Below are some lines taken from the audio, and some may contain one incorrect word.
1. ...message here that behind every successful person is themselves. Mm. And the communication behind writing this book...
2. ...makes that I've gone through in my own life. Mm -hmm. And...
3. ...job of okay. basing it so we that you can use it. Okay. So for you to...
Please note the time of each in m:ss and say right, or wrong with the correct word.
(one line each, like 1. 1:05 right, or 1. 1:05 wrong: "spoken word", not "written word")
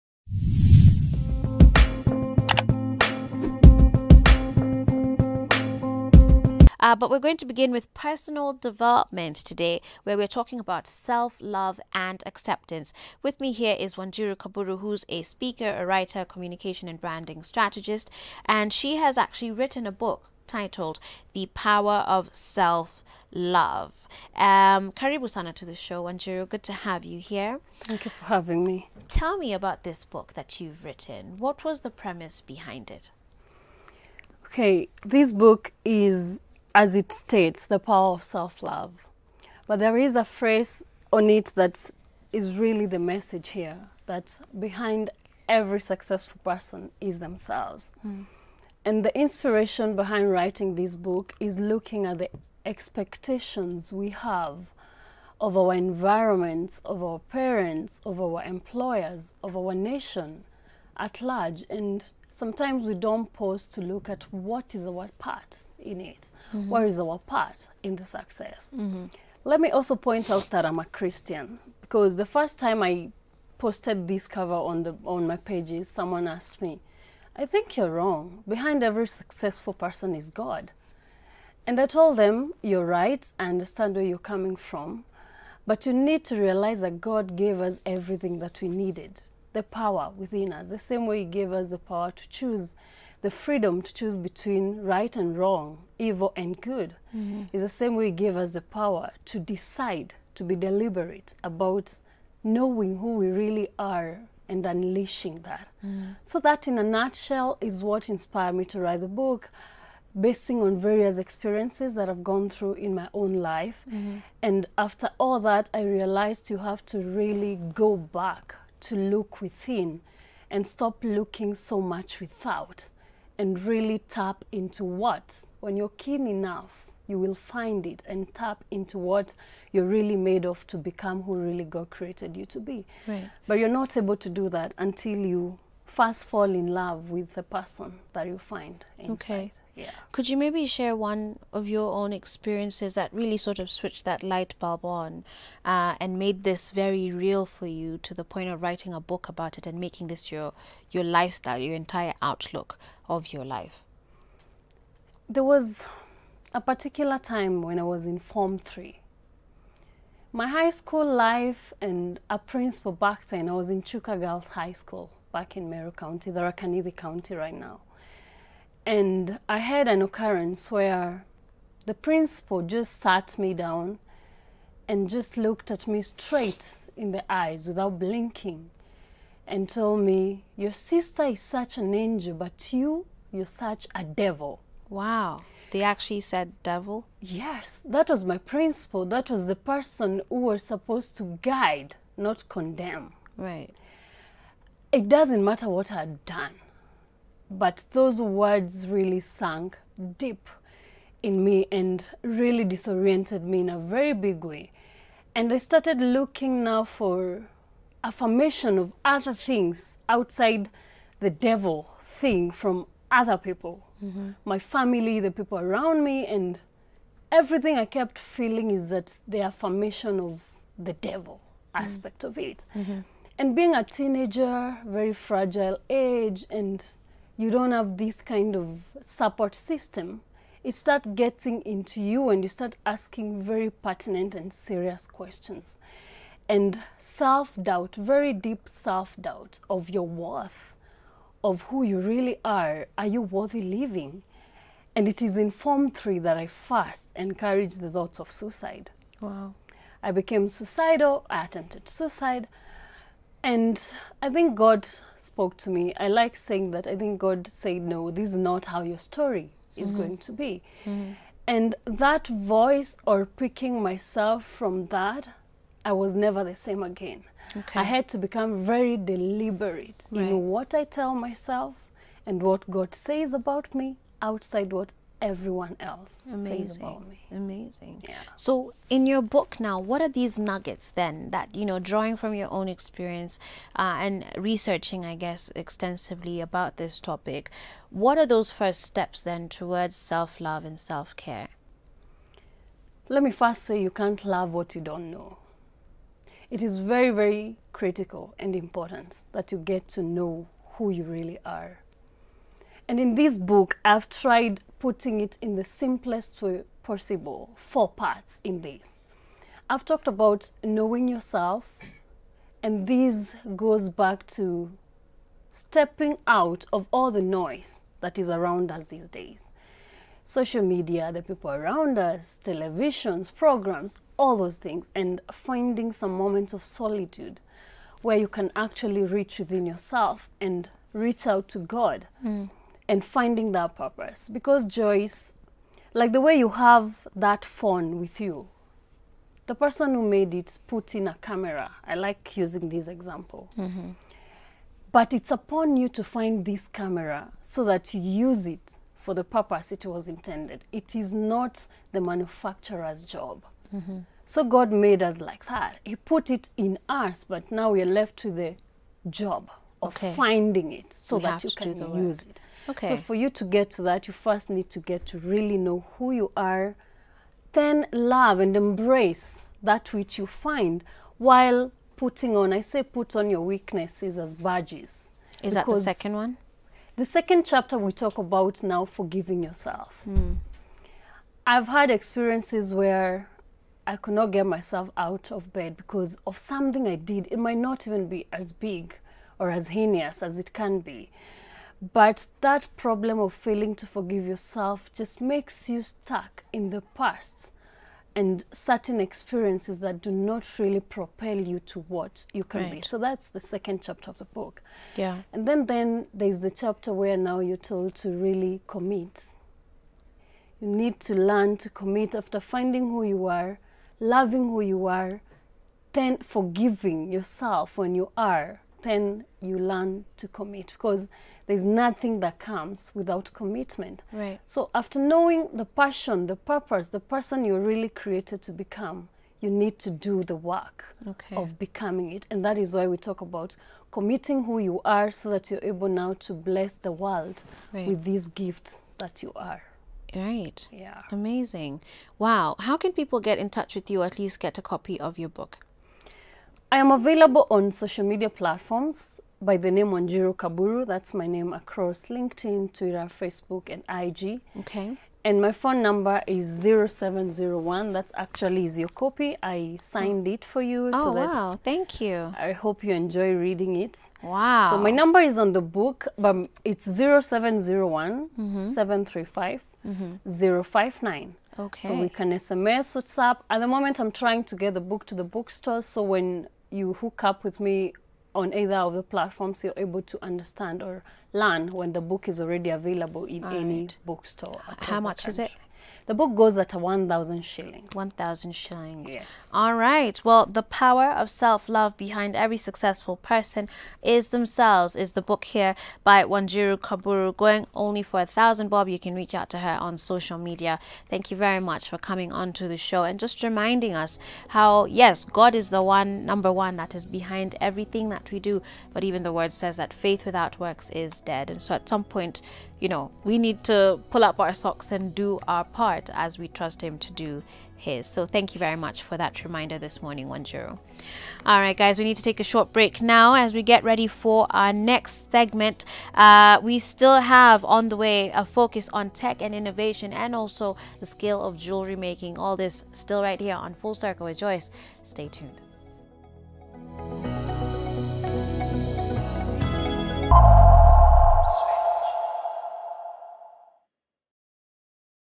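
1. 0:42 wrong: "inspiration", not "communication"
2. 1:51 wrong: "experiences", not "makes"
3. 5:59 wrong: "finding", not "basing".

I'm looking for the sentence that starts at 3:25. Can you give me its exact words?
And I started looking now for affirmation of other things outside the devil thing from other people mm-hmm.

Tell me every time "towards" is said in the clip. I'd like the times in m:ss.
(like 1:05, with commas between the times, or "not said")
4:49.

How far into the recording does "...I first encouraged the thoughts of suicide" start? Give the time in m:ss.
4:06.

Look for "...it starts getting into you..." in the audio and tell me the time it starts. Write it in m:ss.
3:50.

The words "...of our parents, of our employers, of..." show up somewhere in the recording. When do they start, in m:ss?
0:56.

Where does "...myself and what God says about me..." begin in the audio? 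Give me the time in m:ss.
4:31.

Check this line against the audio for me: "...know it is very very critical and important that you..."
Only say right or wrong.
right.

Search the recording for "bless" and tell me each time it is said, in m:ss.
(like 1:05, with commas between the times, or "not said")
7:16.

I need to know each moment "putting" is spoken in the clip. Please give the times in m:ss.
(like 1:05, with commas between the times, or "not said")
5:04, 6:11.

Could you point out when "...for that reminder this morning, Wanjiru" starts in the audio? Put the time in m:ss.
8:39.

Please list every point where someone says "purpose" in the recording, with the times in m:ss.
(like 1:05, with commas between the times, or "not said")
5:33, 5:49, 7:06.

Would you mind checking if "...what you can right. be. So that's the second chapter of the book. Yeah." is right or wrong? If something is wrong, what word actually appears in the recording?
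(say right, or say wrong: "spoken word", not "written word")
right.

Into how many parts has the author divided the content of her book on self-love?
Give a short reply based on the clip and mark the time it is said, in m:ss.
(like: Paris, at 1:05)
4, at 5:07.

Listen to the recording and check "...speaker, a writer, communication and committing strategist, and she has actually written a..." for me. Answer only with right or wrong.
wrong.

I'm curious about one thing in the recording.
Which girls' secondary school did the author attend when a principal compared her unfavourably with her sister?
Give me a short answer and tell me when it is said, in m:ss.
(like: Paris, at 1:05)
Chuka Girls High School, at 2:43.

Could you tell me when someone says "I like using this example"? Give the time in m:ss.
5:41.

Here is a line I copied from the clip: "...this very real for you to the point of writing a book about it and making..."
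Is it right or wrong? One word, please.
right.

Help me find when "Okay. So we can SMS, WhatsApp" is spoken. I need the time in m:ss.
7:51.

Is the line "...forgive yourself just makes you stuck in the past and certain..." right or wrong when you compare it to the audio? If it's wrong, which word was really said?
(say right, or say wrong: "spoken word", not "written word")
right.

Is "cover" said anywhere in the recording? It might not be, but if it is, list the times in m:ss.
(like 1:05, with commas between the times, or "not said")
1:14.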